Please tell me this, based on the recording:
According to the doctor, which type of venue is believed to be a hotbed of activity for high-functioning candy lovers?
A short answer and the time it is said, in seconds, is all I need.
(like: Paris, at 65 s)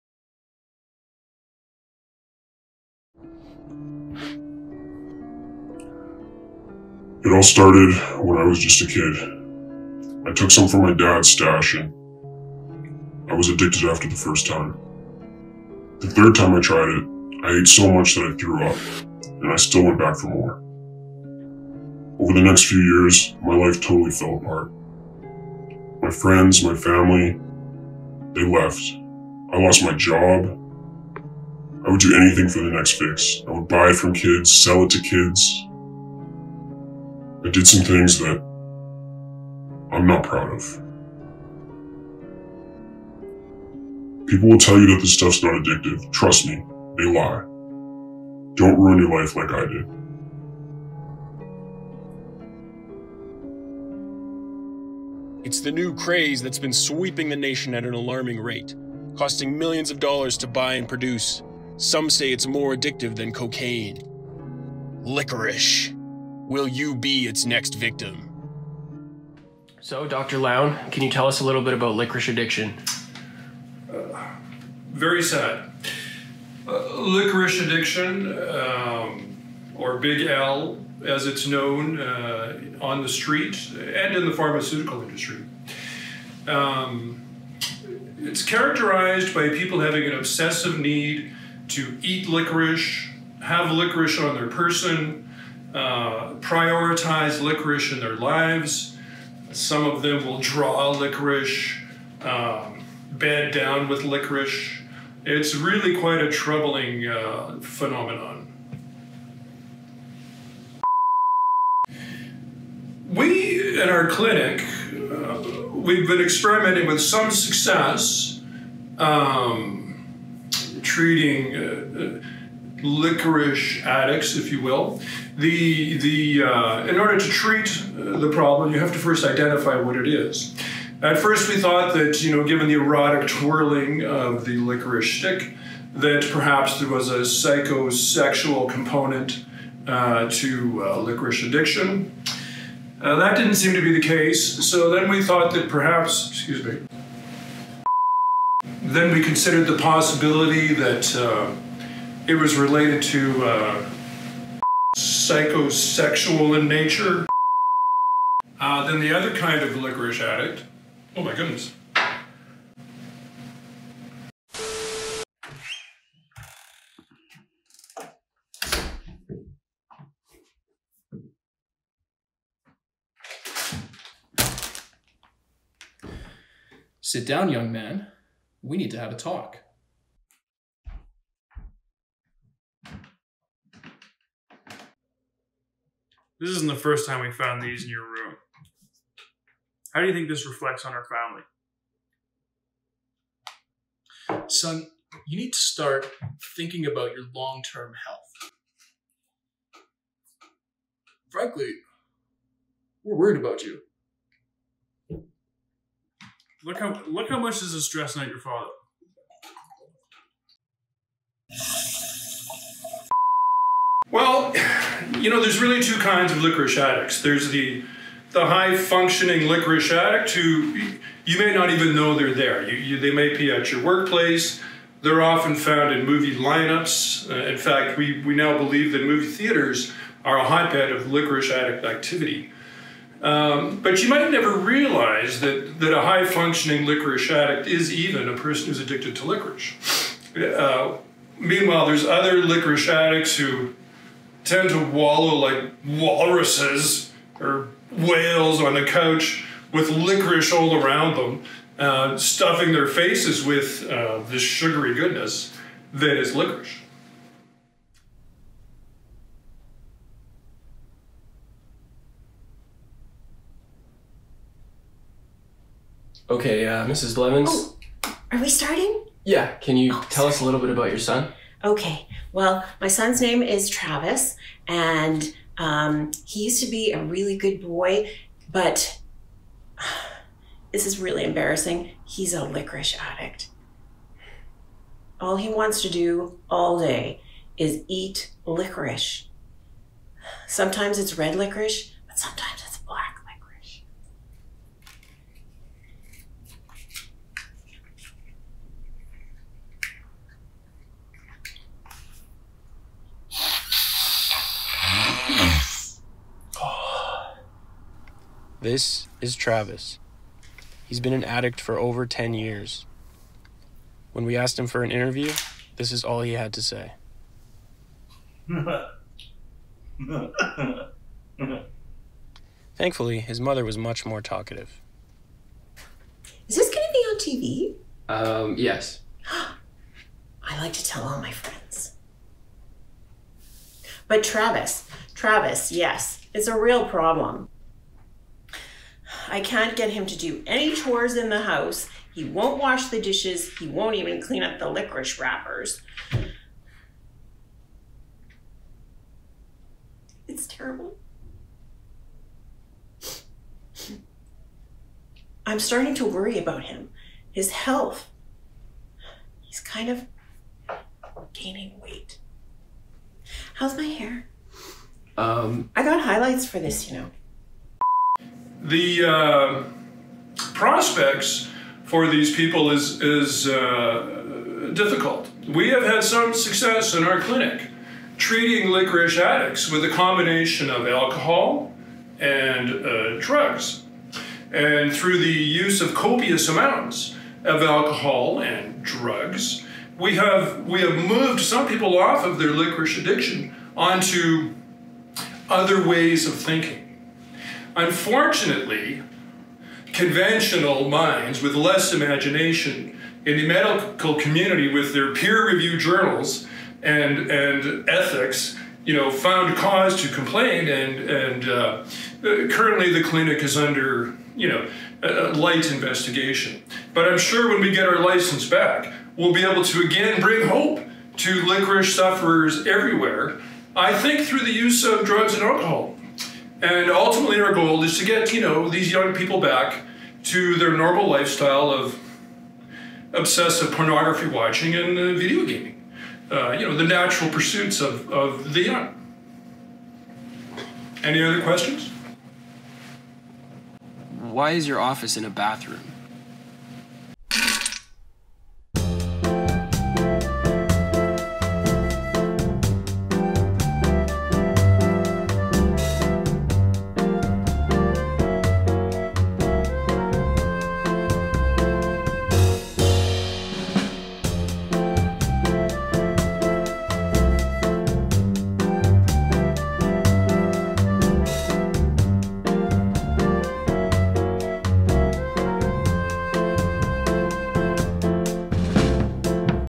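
Movie theaters, at 229 s.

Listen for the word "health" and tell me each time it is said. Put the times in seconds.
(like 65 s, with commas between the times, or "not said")
198 s, 357 s.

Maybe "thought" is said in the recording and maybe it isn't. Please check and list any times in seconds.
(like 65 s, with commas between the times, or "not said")
131 s, 145 s.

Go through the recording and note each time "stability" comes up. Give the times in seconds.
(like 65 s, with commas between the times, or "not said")
not said.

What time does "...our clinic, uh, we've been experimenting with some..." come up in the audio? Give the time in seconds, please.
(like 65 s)
113 s.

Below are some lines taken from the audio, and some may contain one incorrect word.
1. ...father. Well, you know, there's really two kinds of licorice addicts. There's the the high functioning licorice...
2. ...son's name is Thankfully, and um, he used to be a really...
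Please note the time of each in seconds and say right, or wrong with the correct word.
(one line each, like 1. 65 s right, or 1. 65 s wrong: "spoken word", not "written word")
1. 208 s right
2. 272 s wrong: "Travis", not "Thankfully".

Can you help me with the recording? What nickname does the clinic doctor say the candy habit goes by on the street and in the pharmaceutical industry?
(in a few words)
Big L.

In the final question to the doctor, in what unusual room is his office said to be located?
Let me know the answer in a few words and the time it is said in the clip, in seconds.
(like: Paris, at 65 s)
A bathroom, at 445 s.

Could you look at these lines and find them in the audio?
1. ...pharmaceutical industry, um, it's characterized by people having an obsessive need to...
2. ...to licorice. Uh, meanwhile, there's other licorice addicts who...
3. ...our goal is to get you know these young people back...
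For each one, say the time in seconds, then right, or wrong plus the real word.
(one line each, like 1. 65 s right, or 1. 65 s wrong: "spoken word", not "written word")
1. 84 s right
2. 239 s right
3. 427 s right.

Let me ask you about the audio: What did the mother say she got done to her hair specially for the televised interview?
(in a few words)
Highlights.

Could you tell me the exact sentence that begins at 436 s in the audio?
Uh, you know the natural pursuits of, of the young.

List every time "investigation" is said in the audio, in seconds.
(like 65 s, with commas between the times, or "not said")
415 s.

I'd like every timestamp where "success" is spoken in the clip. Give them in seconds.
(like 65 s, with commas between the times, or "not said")
117 s, 376 s.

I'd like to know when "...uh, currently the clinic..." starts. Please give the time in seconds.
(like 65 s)
411 s.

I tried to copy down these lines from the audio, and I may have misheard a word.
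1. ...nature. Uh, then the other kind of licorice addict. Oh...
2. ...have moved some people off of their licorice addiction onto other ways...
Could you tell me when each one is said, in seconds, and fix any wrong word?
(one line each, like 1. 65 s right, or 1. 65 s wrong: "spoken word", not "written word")
1. 156 s right
2. 390 s right.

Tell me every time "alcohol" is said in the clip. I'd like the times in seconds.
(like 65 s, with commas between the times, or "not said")
380 s, 387 s, 425 s.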